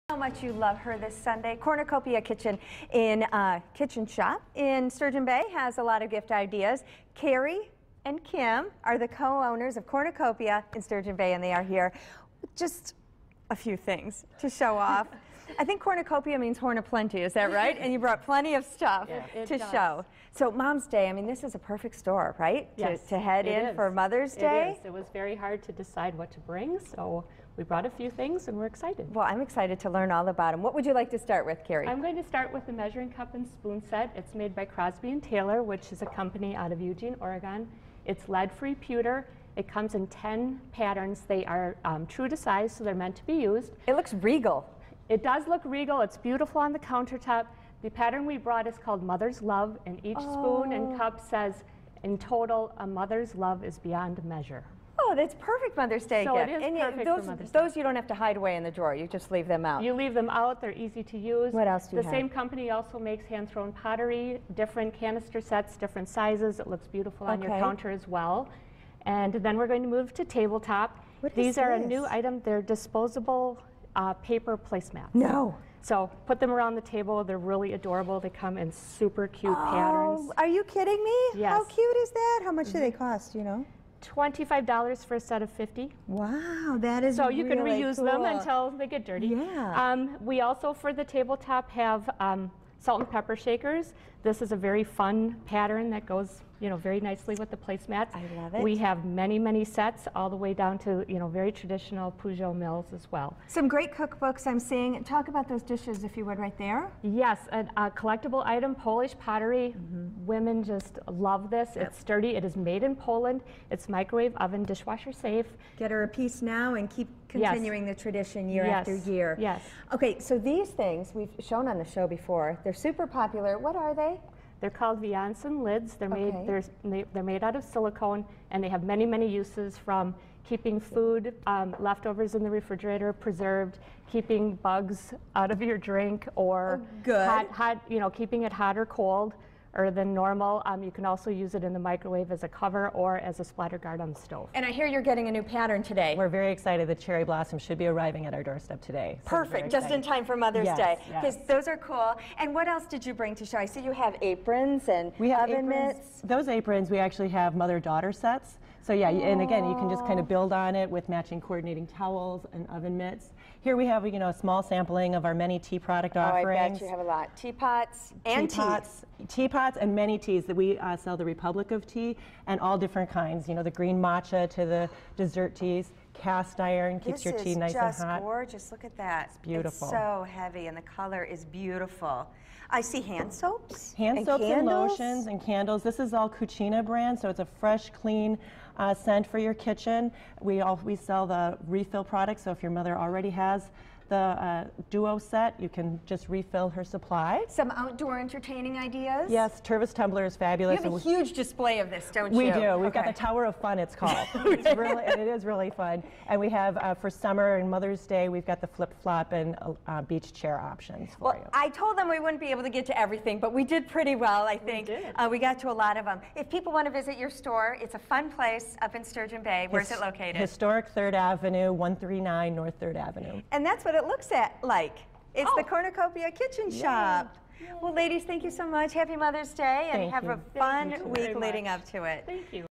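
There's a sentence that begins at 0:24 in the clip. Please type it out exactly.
It was very hard to decide what to bring, so we brought a few things and we're excited.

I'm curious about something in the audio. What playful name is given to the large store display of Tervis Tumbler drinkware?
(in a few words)
Tower of Fun.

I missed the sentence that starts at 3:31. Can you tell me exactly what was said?
I told them we wouldn't be able to get to everything, but we did pretty well, I think.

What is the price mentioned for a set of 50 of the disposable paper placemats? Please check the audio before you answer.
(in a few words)
$25.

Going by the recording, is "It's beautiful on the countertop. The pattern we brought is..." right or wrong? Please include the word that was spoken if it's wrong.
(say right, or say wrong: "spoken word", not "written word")
right.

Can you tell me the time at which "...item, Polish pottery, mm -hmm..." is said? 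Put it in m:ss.
1:48.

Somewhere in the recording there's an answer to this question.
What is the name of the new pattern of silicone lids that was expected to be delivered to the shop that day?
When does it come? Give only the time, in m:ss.
2:26.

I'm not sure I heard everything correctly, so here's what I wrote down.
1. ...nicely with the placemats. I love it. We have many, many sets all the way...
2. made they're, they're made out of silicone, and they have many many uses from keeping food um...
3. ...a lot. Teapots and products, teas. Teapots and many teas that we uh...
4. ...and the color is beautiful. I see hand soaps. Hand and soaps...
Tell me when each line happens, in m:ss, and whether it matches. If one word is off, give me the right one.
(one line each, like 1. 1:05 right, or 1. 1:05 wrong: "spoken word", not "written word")
1. 1:36 right
2. 2:06 right
3. 2:46 wrong: "teapots", not "products"
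4. 3:00 right.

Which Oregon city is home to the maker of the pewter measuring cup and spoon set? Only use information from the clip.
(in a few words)
Eugene.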